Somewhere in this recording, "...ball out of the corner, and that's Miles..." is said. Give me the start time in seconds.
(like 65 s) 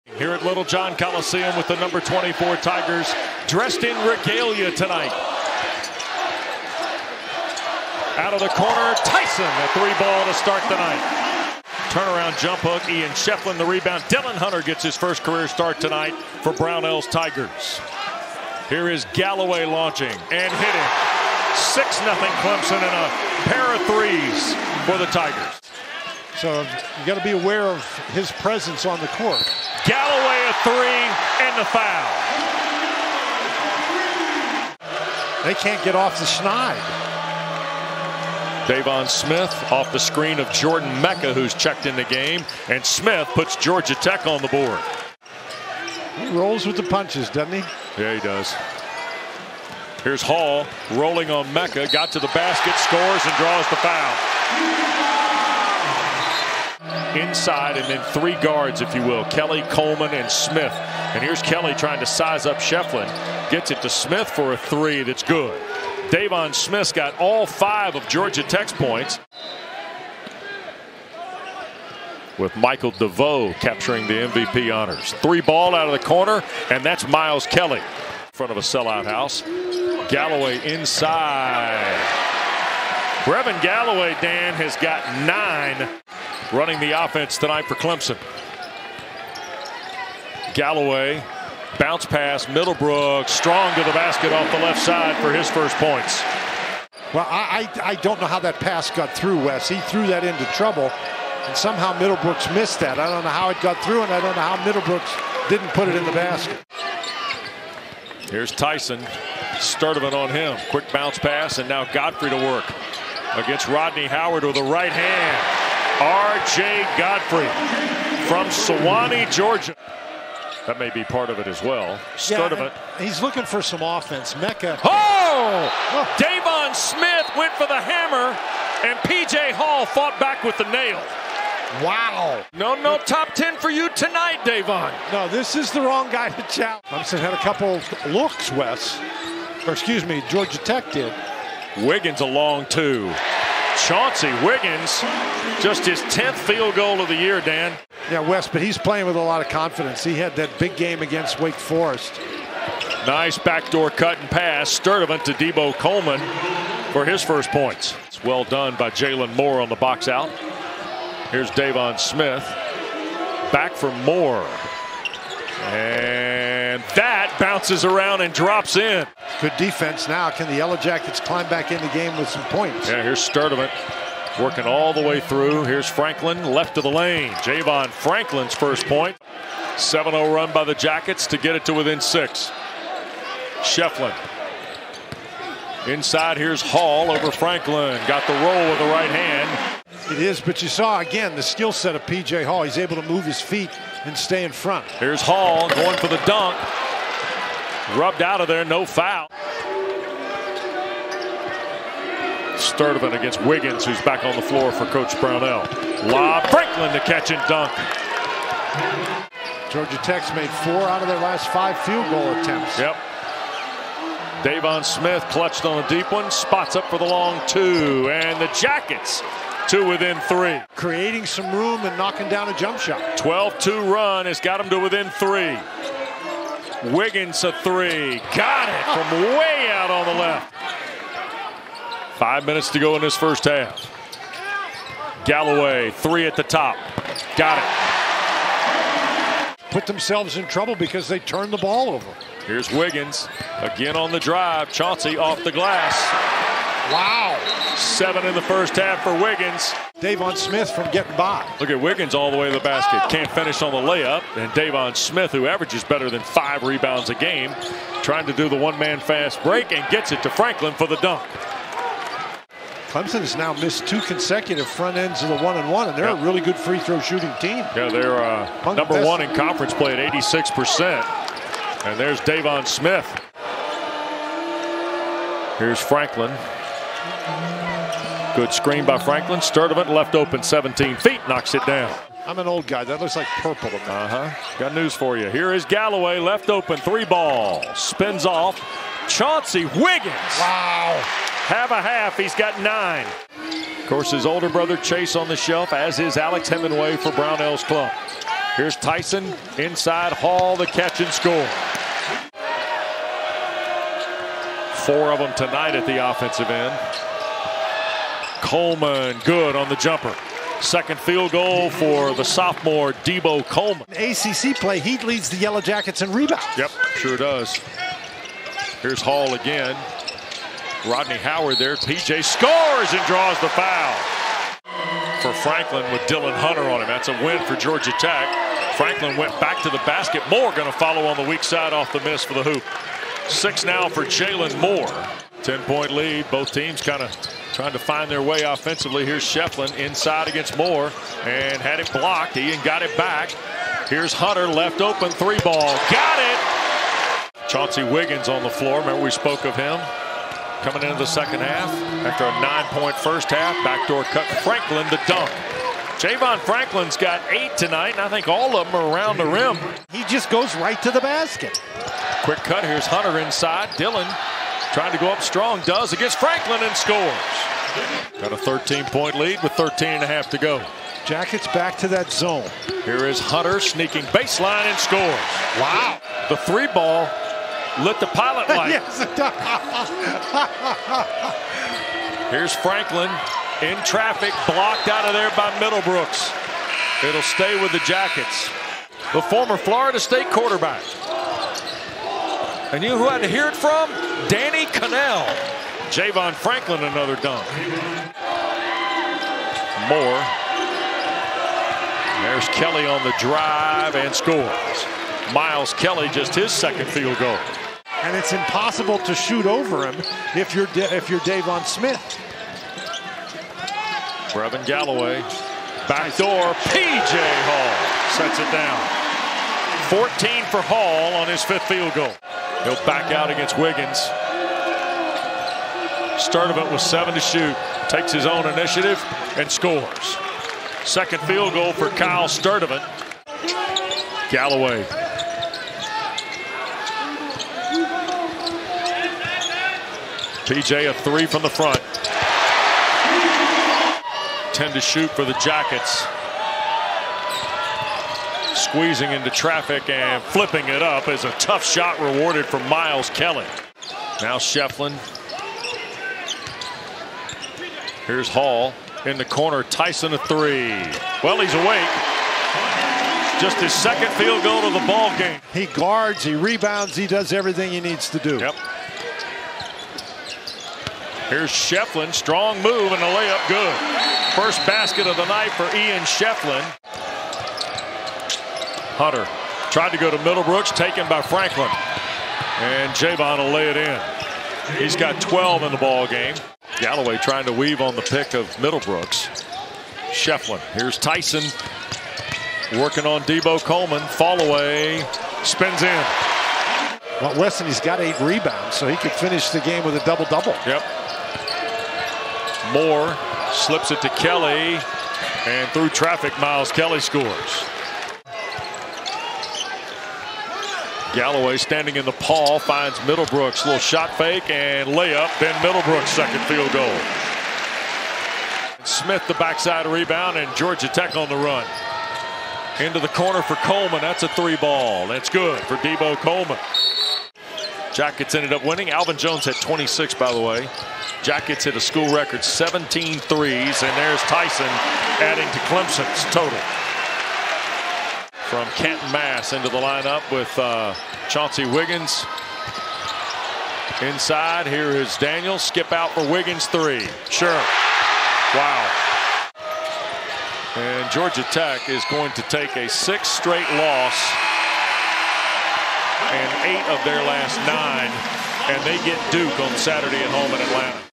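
75 s.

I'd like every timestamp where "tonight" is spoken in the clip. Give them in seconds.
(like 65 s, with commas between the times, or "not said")
4 s, 15 s, 87 s, 133 s, 305 s, 357 s.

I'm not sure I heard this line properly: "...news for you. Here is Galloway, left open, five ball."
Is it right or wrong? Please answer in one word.
wrong.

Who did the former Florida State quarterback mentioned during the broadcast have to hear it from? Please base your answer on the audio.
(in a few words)
Danny Kanell.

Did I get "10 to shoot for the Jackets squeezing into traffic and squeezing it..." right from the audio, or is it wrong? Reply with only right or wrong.
wrong.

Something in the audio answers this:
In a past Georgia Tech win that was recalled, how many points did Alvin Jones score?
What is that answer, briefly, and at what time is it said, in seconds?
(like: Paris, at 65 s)
26, at 529 s.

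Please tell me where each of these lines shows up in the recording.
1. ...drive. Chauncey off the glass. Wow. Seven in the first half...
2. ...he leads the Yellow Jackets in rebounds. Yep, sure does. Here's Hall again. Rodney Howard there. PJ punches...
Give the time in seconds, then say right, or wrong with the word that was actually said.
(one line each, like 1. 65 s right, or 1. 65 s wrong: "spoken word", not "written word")
1. 244 s right
2. 314 s wrong: "scores", not "punches".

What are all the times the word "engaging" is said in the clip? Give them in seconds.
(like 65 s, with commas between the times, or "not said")
not said.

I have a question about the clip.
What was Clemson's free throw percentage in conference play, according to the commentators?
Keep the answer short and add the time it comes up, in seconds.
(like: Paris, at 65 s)
86%, at 270 s.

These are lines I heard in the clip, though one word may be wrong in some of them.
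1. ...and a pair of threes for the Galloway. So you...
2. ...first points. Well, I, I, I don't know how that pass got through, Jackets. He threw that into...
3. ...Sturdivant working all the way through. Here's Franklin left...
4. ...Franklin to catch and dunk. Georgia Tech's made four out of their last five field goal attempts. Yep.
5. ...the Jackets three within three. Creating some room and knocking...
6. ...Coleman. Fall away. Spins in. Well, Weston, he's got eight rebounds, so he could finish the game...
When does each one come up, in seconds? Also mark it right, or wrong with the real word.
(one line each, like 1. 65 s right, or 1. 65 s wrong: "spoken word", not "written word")
1. 22 s wrong: "Tigers", not "Galloway"
2. 95 s wrong: "Wes", not "Jackets"
3. 173 s right
4. 206 s right
5. 218 s wrong: "two", not "three"
6. 493 s right.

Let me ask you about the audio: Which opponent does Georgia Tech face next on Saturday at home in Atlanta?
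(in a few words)
Duke.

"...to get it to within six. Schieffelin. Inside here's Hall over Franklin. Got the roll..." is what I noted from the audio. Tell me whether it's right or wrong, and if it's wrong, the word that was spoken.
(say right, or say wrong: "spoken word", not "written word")
right.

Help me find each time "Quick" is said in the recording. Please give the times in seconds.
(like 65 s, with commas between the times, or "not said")
110 s, 362 s.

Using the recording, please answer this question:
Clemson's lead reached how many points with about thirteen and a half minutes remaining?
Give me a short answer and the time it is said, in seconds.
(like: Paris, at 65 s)
13, at 368 s.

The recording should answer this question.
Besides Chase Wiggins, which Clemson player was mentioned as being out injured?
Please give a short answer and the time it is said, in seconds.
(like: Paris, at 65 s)
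Alex Hemenway, at 296 s.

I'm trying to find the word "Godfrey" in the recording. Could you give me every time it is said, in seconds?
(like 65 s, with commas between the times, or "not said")
111 s, 116 s.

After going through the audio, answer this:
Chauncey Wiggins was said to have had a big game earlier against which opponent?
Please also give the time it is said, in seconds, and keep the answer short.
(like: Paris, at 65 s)
Wake Forest, at 151 s.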